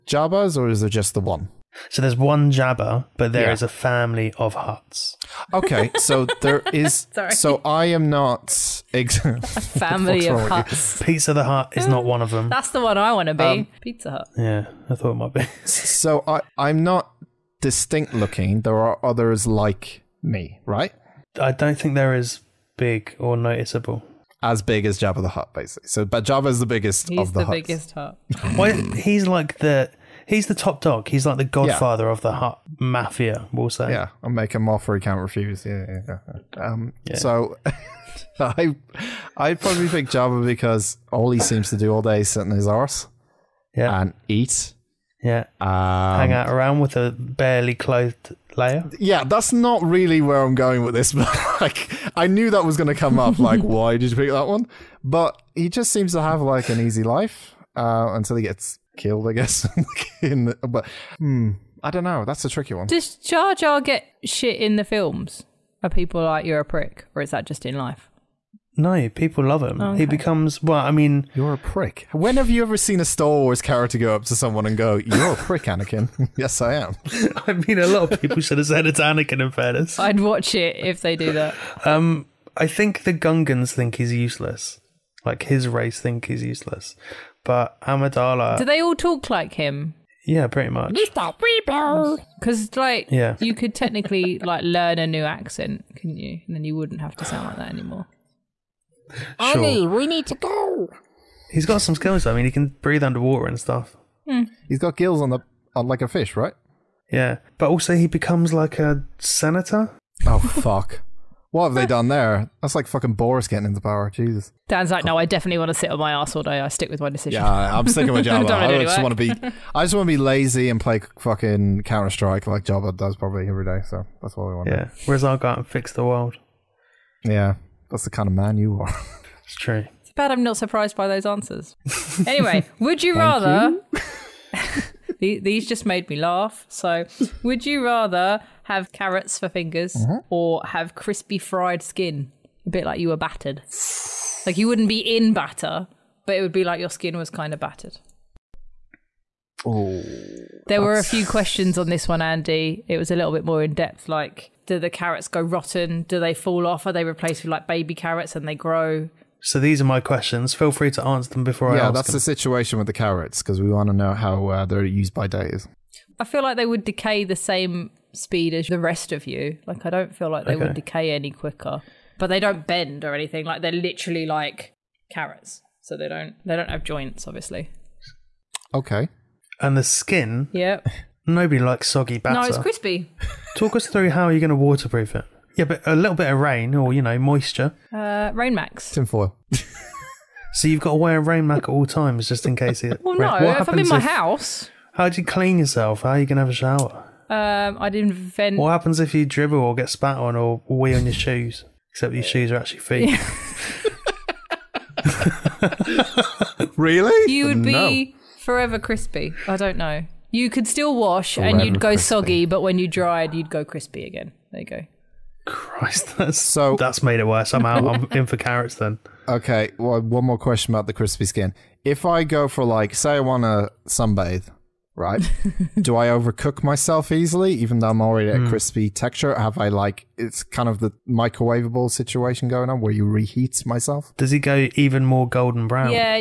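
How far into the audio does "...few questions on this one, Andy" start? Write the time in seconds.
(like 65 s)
151 s.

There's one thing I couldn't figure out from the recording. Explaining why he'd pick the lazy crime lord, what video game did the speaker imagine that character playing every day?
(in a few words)
Counter Strike.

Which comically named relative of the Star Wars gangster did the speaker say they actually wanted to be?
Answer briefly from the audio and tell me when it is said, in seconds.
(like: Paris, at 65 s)
Pizza the Hutt, at 11 s.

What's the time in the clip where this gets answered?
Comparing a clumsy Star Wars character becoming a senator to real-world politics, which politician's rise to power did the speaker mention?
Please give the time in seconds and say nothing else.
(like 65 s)
113 s.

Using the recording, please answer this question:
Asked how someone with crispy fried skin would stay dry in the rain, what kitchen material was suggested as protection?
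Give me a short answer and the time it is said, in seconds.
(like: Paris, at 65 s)
Tinfoil, at 188 s.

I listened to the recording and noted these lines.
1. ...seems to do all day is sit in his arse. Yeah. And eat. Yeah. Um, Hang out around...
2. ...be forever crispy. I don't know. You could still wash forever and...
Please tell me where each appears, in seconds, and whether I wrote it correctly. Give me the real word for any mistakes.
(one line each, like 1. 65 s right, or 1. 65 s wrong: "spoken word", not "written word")
1. 41 s right
2. 207 s right.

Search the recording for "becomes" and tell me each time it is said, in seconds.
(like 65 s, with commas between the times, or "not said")
70 s, 108 s.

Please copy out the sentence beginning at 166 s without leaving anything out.
I feel like they would decay the same speed as the rest of you.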